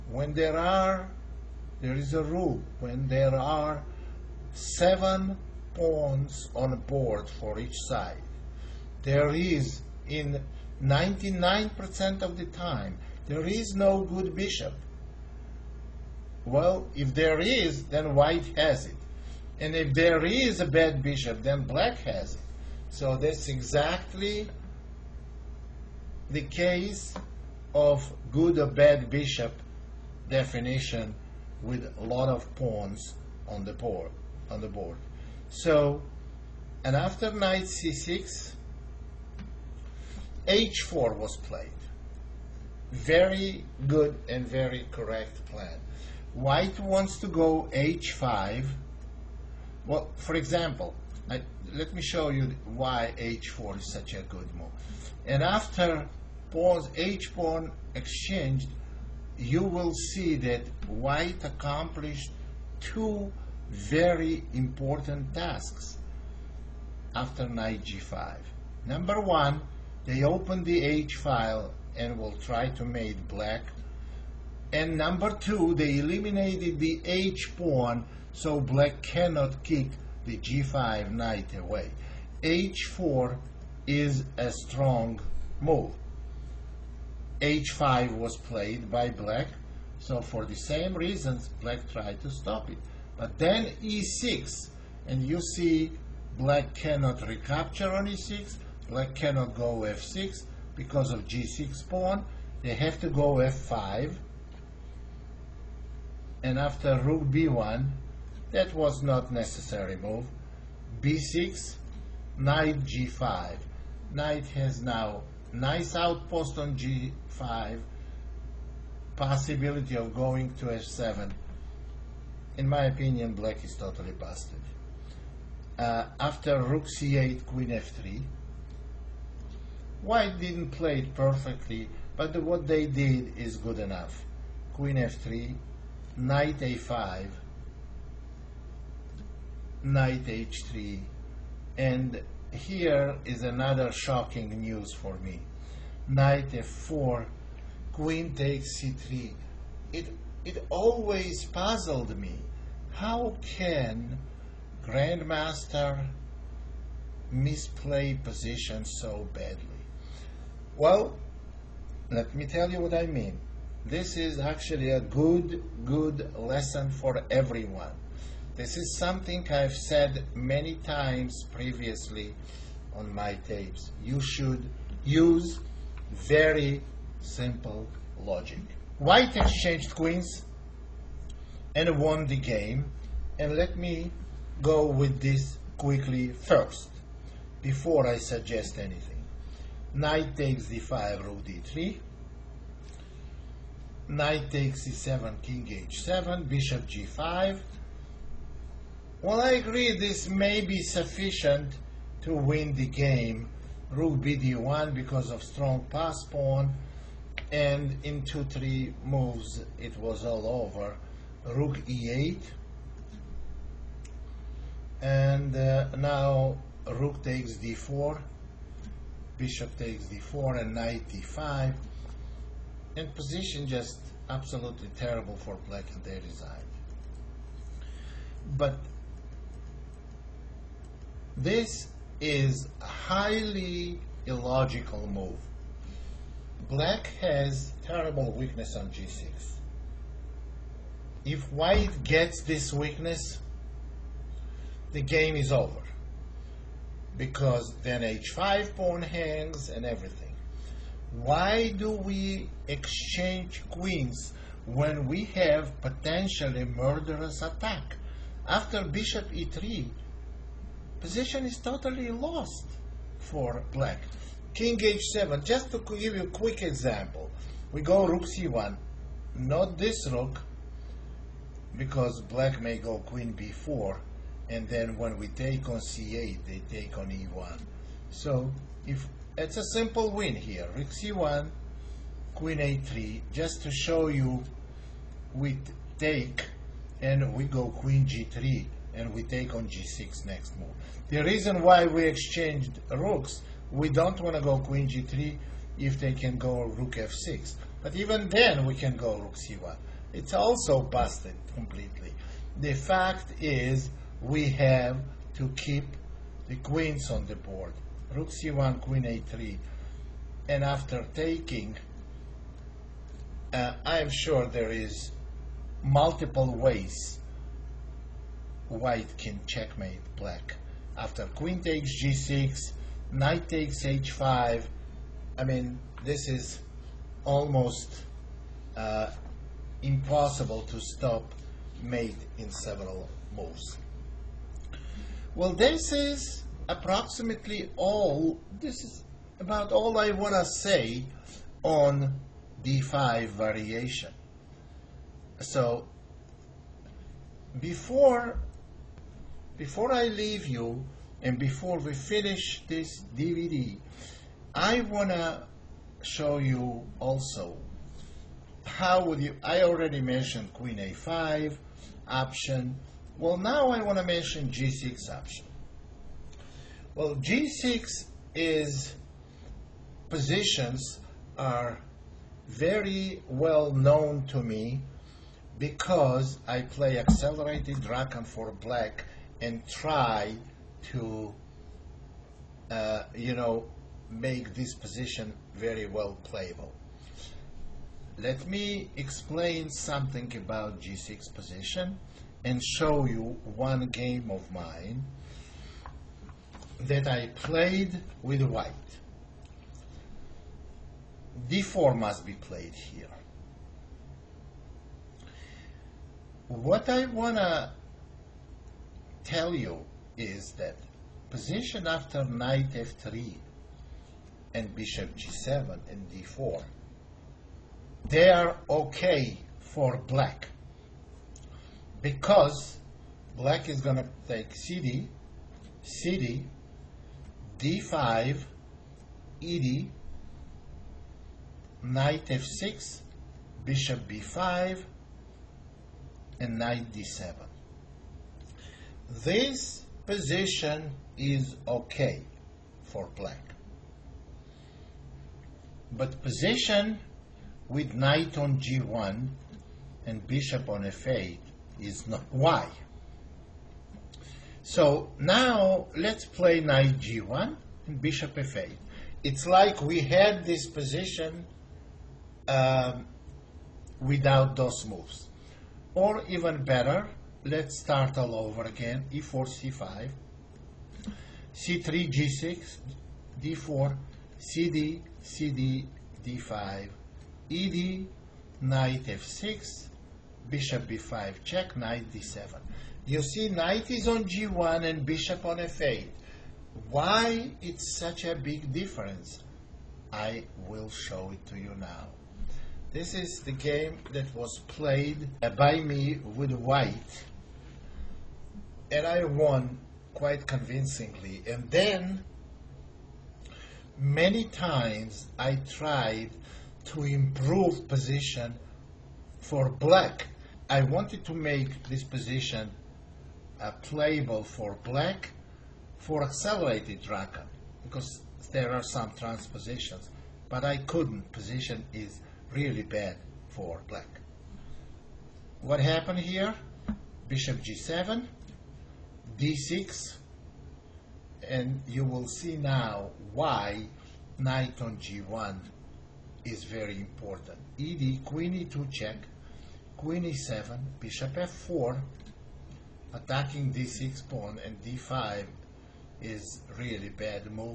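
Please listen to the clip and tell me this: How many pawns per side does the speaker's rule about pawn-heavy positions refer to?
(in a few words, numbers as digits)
7.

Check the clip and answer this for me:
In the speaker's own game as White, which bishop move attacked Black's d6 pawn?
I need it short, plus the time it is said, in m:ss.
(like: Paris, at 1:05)
Bishop f4, at 9:01.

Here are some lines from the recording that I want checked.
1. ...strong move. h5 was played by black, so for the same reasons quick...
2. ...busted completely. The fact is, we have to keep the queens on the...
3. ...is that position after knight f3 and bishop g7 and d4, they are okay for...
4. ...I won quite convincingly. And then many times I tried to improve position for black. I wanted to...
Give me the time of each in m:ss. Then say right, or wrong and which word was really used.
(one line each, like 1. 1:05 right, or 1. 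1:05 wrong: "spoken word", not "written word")
1. 1:24 wrong: "black", not "quick"
2. 5:00 right
3. 6:50 right
4. 8:19 right.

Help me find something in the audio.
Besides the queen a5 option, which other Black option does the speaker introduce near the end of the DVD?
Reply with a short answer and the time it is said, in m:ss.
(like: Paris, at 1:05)
g6, at 6:04.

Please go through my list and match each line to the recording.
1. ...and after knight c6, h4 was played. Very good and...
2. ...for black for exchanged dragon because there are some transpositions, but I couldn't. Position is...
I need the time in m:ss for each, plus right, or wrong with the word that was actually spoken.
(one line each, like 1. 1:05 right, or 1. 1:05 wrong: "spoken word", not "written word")
1. 0:36 right
2. 8:34 wrong: "accelerated", not "exchanged".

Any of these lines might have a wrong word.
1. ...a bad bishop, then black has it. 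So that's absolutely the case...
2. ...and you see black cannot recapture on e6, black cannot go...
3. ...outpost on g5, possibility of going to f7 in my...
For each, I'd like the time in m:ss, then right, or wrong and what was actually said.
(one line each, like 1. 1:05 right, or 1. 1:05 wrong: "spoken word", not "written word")
1. 0:20 wrong: "exactly", not "absolutely"
2. 1:35 right
3. 1:55 right.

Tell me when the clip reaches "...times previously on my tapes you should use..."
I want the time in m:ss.
2:50.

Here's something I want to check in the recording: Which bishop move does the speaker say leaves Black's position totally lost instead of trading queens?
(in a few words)
Bishop e3.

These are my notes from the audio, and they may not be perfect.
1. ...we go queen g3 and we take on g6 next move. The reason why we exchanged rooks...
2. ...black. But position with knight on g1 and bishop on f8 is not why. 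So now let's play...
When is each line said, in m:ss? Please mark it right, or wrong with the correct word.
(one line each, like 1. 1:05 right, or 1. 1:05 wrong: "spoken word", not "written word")
1. 4:47 right
2. 7:23 right.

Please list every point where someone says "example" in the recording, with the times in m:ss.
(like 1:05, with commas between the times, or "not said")
0:50, 4:26.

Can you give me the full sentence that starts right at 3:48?
but this is a highly illogical move black has terrible weakness on g6.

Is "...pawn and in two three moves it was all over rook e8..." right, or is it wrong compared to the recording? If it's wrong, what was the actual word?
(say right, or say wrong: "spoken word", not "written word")
right.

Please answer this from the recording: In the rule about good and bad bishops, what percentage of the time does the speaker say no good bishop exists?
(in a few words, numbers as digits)
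99%.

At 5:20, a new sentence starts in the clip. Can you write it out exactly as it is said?
After queen takes g6, knight takes h5.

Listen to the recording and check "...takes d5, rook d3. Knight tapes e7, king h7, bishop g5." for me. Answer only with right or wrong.
wrong.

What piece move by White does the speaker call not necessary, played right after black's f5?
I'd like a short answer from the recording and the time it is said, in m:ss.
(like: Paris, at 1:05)
Rook b1, at 1:46.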